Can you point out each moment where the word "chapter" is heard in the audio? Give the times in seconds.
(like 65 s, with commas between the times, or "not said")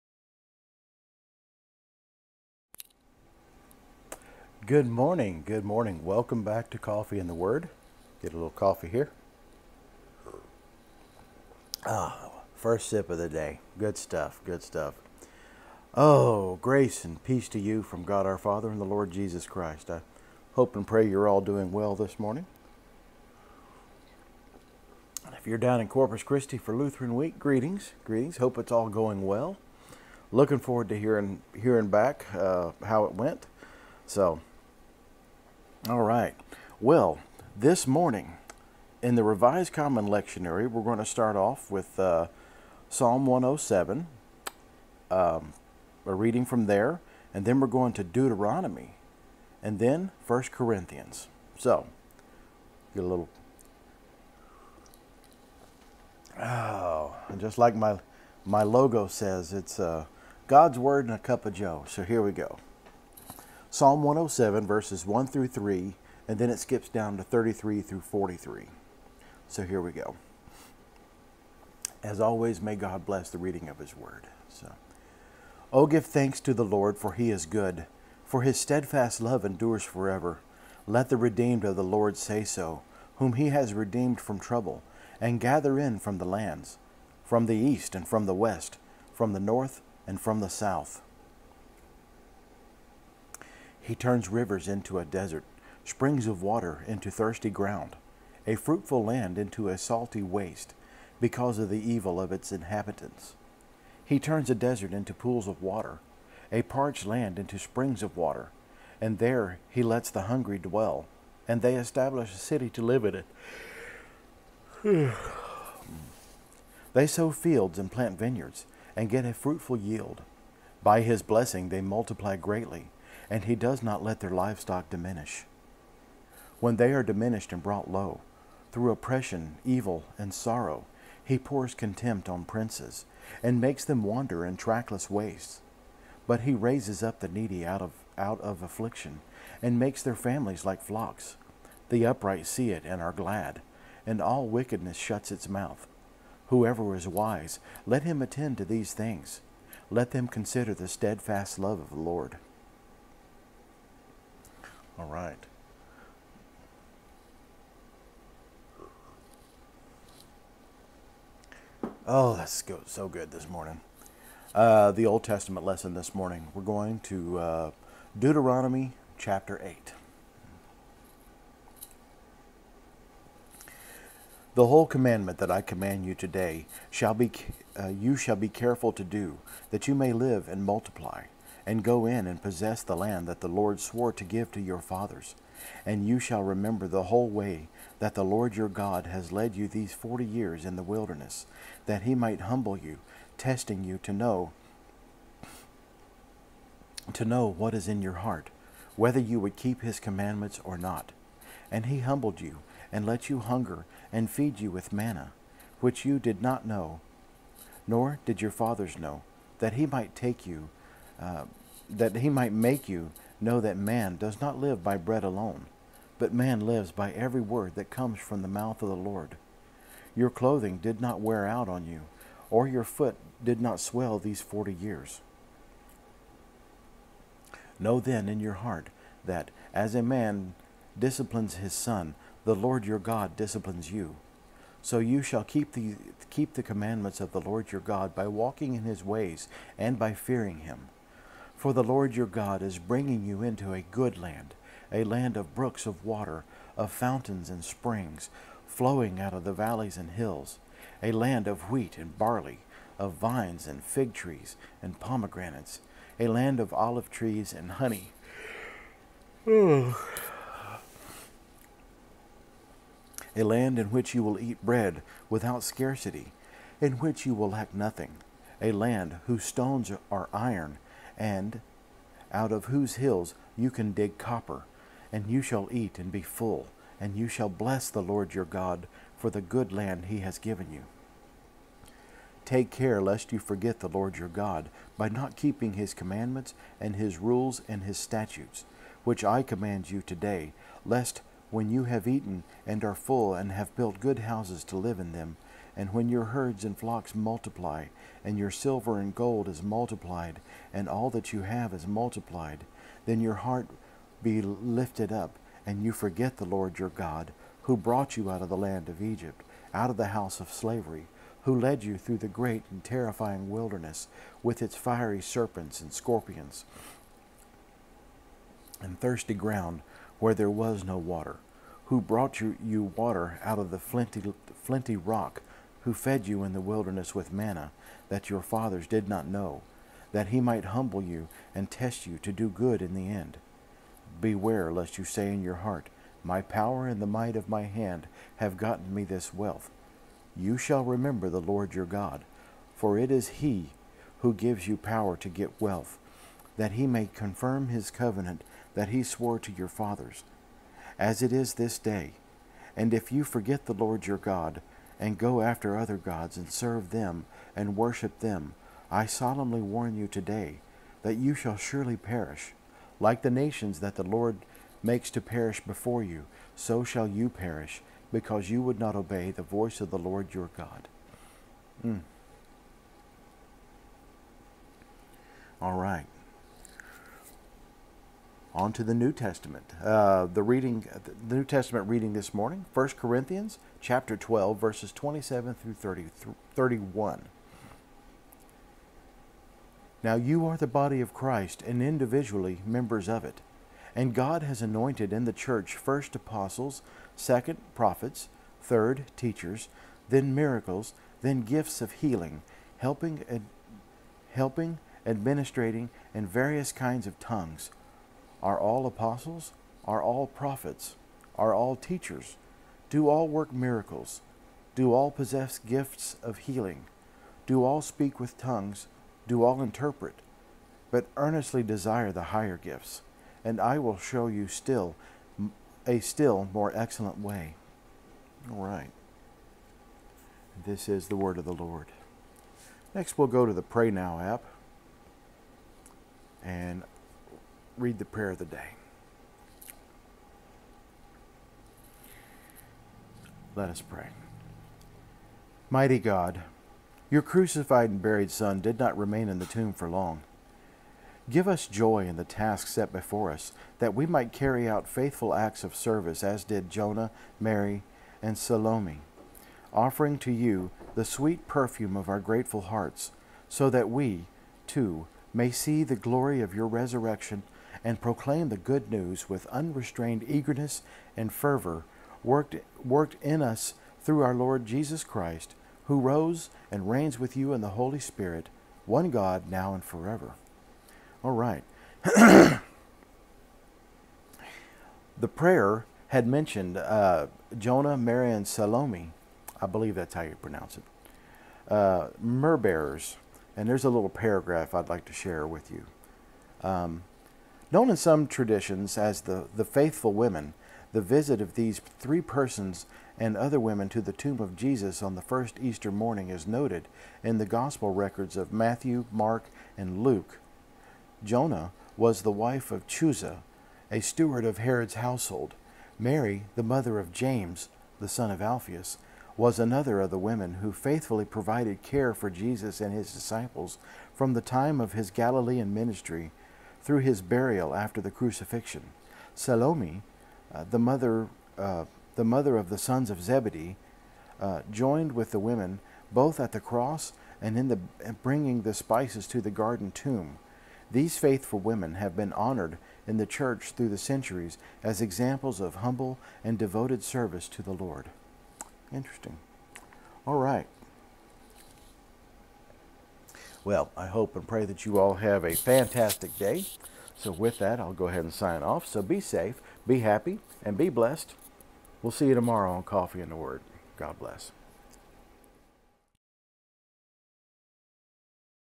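169 s, 383 s.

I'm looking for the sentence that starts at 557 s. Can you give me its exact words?
So, with that, I'll go ahead and sign off.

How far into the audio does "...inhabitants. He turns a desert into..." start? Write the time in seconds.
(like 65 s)
102 s.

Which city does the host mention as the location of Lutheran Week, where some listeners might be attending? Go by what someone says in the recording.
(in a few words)
Corpus Christi.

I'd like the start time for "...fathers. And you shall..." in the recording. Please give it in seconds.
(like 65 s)
184 s.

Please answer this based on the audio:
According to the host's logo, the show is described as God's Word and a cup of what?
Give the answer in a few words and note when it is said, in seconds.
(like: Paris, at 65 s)
Joe, at 61 s.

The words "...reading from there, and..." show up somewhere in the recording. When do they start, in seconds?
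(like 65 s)
46 s.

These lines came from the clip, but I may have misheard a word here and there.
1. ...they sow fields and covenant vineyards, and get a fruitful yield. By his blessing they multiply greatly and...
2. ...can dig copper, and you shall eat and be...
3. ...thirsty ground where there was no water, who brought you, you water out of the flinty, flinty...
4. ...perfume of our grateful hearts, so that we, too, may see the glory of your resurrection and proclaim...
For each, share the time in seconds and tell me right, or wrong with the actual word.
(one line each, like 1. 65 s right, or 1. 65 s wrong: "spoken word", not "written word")
1. 116 s wrong: "plant", not "covenant"
2. 273 s right
3. 318 s right
4. 461 s right.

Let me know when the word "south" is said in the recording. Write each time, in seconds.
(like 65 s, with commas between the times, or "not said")
90 s.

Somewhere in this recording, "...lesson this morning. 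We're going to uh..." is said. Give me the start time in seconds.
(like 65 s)
165 s.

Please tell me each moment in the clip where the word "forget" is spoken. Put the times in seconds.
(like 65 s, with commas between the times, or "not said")
283 s, 305 s, 353 s.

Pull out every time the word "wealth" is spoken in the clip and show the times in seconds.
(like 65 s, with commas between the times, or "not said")
339 s, 345 s.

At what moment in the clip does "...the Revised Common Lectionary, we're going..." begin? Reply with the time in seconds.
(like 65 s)
39 s.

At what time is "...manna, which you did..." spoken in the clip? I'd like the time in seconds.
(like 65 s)
204 s.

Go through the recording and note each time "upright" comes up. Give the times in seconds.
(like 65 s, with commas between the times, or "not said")
142 s.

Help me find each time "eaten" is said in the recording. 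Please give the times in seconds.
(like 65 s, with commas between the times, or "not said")
292 s.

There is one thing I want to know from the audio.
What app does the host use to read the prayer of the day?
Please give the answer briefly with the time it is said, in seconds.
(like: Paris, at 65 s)
Pray Now, at 433 s.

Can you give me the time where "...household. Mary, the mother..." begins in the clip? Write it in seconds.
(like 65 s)
514 s.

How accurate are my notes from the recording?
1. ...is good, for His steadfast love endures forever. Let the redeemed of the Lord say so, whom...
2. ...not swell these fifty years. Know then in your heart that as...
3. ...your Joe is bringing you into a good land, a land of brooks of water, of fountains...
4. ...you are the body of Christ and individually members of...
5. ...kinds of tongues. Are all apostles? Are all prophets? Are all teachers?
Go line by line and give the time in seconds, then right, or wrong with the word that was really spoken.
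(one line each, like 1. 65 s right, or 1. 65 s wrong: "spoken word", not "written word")
1. 77 s right
2. 223 s wrong: "forty", not "fifty"
3. 242 s wrong: "God", not "Joe"
4. 390 s right
5. 406 s right.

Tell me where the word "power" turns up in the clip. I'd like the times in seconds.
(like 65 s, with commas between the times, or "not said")
336 s, 344 s.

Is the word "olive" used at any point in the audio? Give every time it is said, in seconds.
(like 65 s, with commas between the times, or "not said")
256 s.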